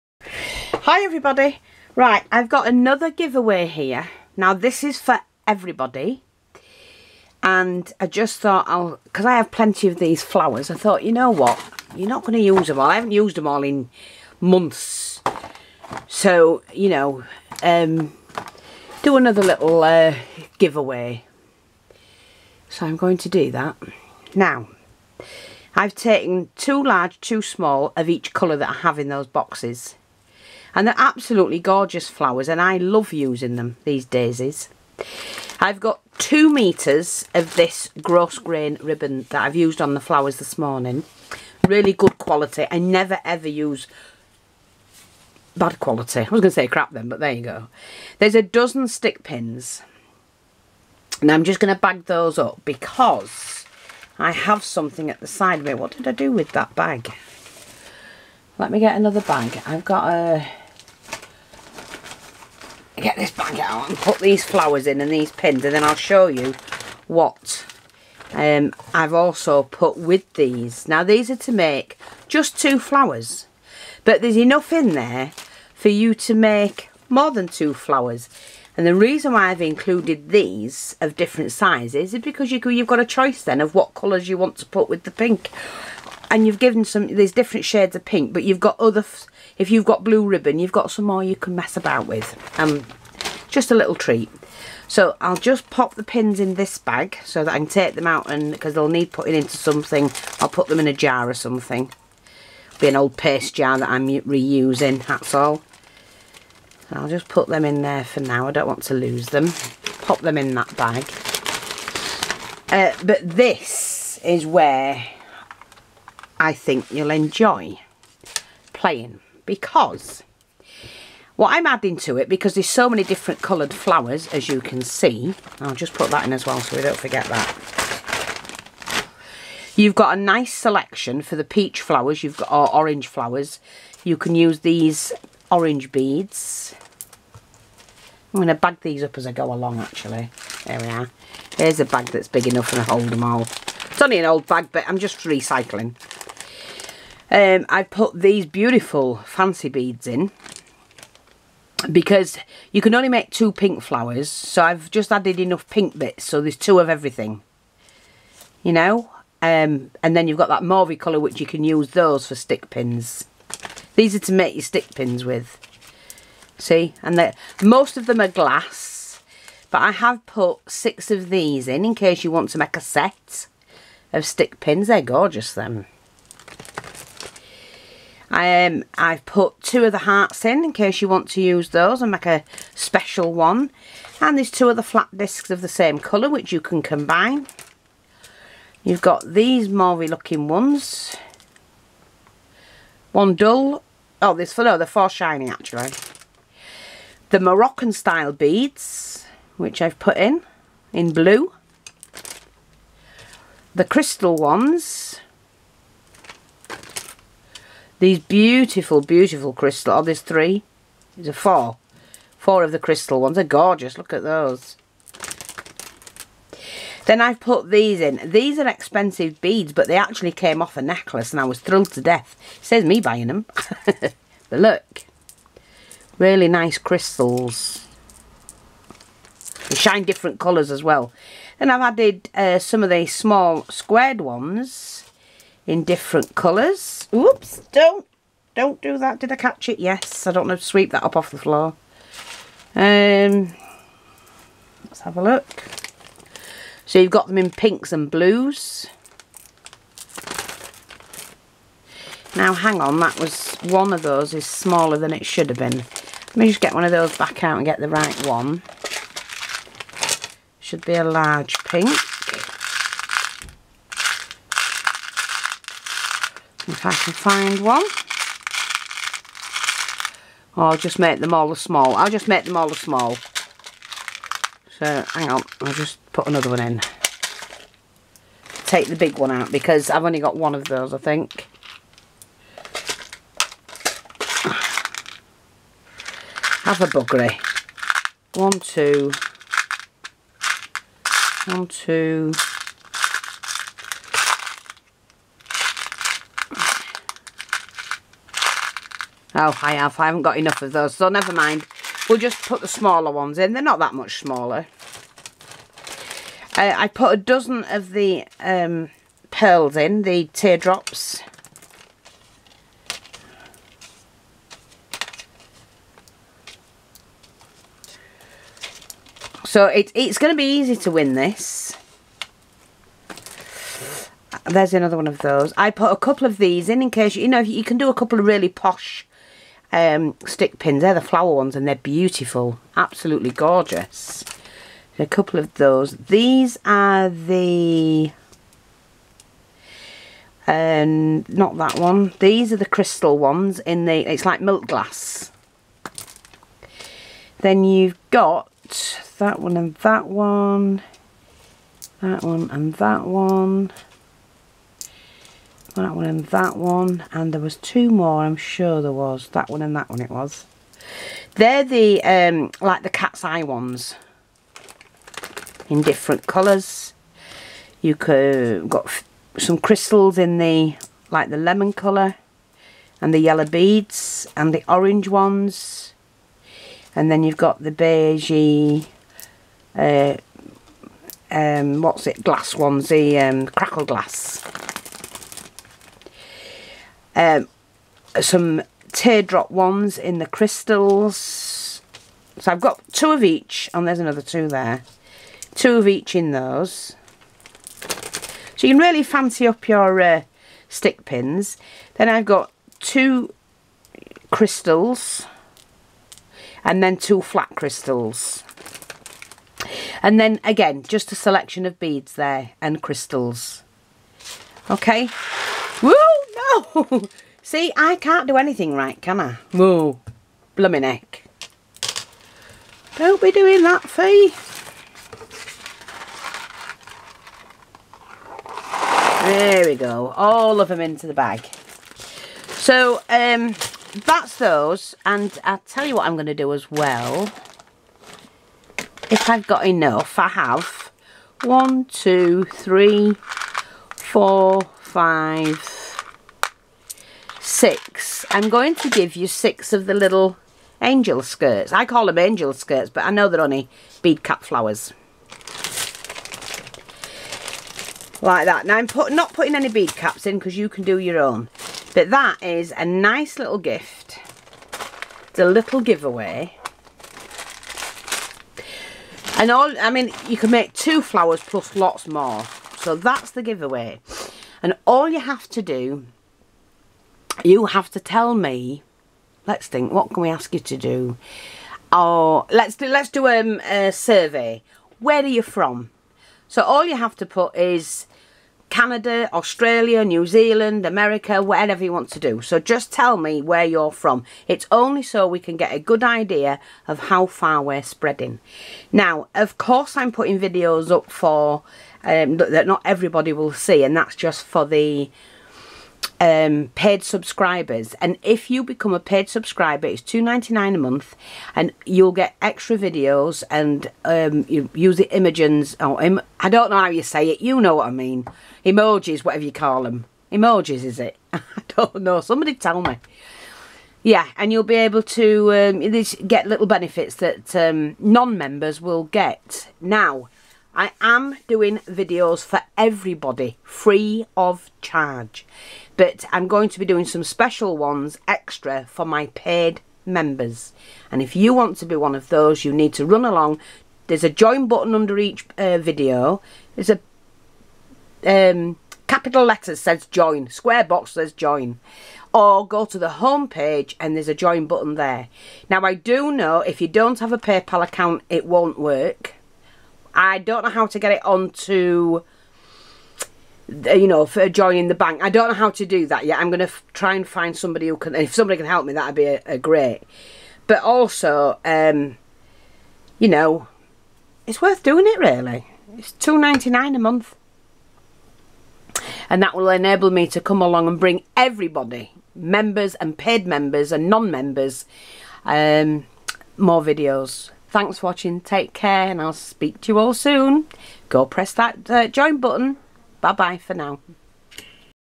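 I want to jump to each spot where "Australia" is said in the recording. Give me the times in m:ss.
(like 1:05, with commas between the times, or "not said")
8:09.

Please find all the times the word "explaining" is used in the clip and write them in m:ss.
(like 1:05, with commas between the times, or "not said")
not said.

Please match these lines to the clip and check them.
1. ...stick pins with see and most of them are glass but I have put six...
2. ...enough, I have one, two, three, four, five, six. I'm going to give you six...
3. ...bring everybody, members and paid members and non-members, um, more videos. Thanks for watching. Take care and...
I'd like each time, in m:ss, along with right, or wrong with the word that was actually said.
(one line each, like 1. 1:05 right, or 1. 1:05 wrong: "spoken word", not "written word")
1. 2:44 right
2. 7:19 right
3. 9:40 right.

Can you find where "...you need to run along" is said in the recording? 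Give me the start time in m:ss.
9:02.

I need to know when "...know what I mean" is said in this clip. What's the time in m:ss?
8:37.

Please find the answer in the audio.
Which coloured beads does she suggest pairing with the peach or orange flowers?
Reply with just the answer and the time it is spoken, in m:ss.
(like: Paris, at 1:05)
Orange beads, at 2:15.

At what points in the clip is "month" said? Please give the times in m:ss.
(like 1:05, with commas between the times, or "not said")
0:14, 8:30, 9:36.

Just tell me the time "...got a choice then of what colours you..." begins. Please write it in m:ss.
1:22.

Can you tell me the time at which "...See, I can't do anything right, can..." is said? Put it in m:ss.
6:57.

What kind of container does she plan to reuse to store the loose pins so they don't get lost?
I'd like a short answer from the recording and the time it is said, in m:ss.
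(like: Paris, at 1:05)
Old paste jar, at 1:42.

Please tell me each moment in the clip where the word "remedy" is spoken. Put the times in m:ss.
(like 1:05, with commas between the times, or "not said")
not said.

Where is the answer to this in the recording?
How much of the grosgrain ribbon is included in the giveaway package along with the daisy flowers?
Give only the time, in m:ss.
0:36.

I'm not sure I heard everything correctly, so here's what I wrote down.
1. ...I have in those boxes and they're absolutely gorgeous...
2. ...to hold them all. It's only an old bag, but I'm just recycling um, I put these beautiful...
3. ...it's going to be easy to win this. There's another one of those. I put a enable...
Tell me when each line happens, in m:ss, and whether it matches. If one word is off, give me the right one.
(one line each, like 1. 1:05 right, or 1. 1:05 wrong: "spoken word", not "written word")
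1. 0:28 right
2. 2:22 right
3. 5:19 wrong: "couple", not "enable".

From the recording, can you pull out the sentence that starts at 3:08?
You've got these mauvey looking ones.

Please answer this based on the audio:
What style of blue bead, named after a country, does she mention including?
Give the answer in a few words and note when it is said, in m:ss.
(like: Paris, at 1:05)
Moroccan style beads, at 3:17.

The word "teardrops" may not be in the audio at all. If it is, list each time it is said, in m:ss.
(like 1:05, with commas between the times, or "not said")
5:10, 6:28.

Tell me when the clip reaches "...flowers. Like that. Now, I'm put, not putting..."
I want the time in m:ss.
7:34.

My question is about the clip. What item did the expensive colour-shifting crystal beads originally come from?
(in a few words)
A necklace.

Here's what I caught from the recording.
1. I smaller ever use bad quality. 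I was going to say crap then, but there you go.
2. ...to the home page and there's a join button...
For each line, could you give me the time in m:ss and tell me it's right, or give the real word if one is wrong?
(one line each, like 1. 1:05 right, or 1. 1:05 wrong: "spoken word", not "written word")
1. 0:42 wrong: "never", not "smaller"
2. 9:12 right.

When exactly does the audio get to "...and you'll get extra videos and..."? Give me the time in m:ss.
8:31.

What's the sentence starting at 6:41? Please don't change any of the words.
Then I've got two crystals and then two flat crystals.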